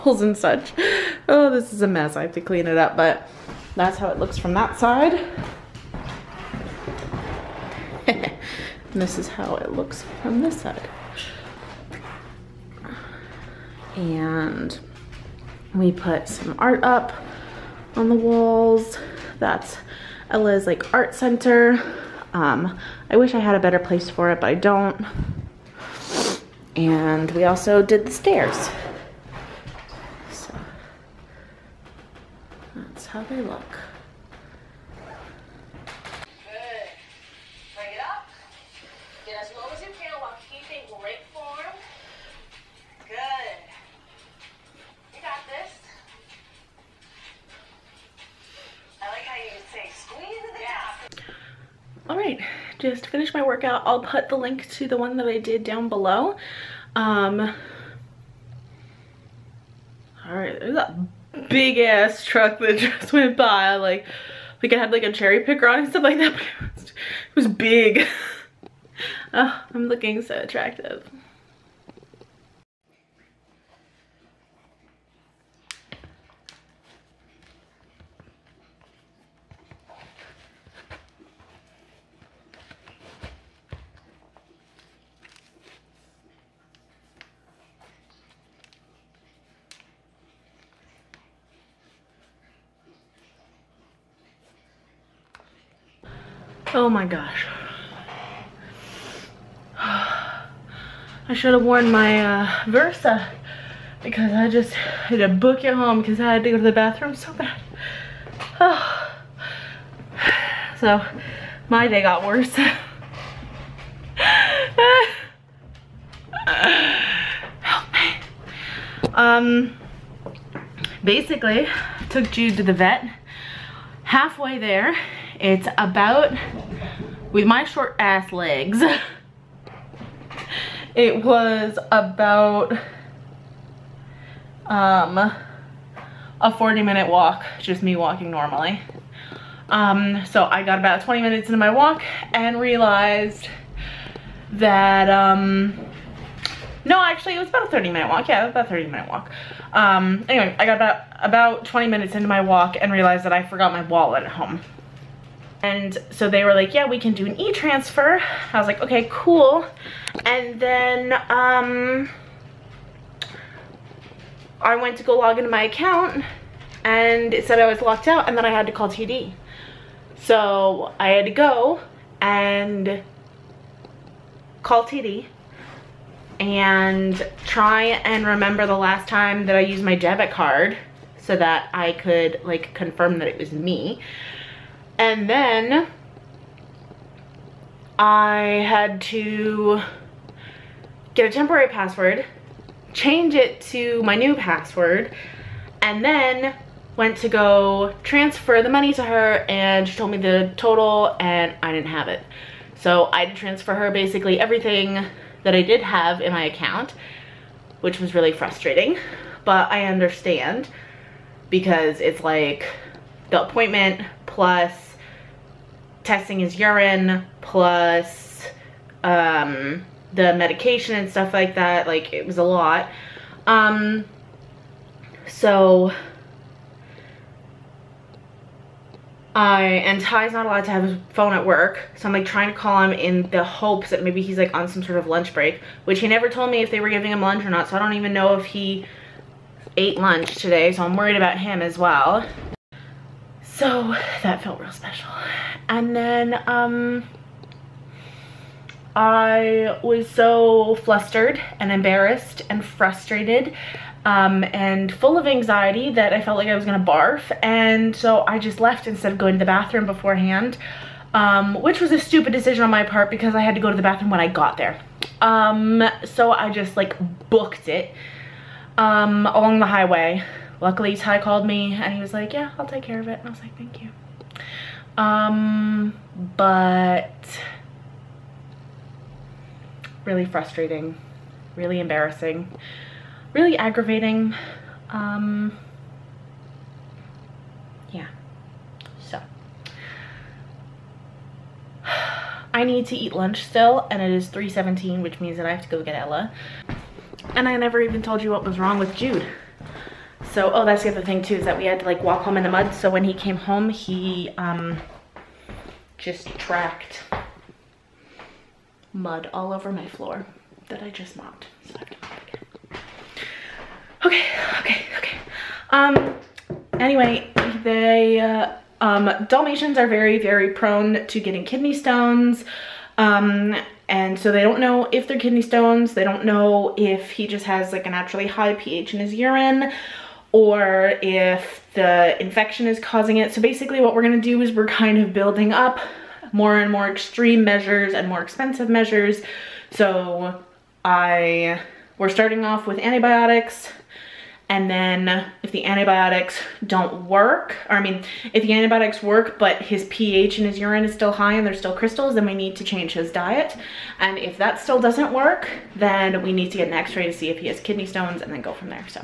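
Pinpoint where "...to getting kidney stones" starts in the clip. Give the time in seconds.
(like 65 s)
321 s.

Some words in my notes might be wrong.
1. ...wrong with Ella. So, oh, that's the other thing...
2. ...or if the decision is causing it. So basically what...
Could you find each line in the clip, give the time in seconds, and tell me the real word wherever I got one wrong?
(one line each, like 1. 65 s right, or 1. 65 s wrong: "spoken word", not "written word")
1. 298 s wrong: "Jude", not "Ella"
2. 330 s wrong: "infection", not "decision".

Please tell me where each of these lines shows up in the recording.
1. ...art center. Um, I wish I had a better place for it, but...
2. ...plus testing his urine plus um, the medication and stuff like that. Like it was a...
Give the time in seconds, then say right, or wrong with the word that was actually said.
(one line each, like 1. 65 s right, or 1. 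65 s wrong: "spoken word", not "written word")
1. 20 s right
2. 214 s right.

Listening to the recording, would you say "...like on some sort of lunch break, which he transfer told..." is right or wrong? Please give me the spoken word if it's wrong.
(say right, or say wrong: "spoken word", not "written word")
wrong: "never", not "transfer".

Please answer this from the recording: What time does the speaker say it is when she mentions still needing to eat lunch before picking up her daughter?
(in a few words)
3:17.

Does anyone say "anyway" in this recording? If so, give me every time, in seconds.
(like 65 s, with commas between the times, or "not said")
150 s, 316 s.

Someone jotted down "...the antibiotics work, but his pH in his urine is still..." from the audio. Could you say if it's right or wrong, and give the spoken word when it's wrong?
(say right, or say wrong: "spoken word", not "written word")
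right.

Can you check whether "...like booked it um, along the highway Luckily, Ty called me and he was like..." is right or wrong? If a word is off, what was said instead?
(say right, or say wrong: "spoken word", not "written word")
right.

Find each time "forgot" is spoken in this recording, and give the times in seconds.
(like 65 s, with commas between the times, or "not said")
153 s.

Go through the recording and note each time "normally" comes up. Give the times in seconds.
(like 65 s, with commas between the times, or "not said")
138 s.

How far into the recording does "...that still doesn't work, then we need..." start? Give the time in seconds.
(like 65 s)
354 s.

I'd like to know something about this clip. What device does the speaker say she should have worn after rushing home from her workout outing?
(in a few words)
Versa.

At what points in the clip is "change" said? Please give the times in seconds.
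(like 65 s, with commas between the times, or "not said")
192 s, 352 s.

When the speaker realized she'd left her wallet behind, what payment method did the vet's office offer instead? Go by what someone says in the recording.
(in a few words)
e-transfer.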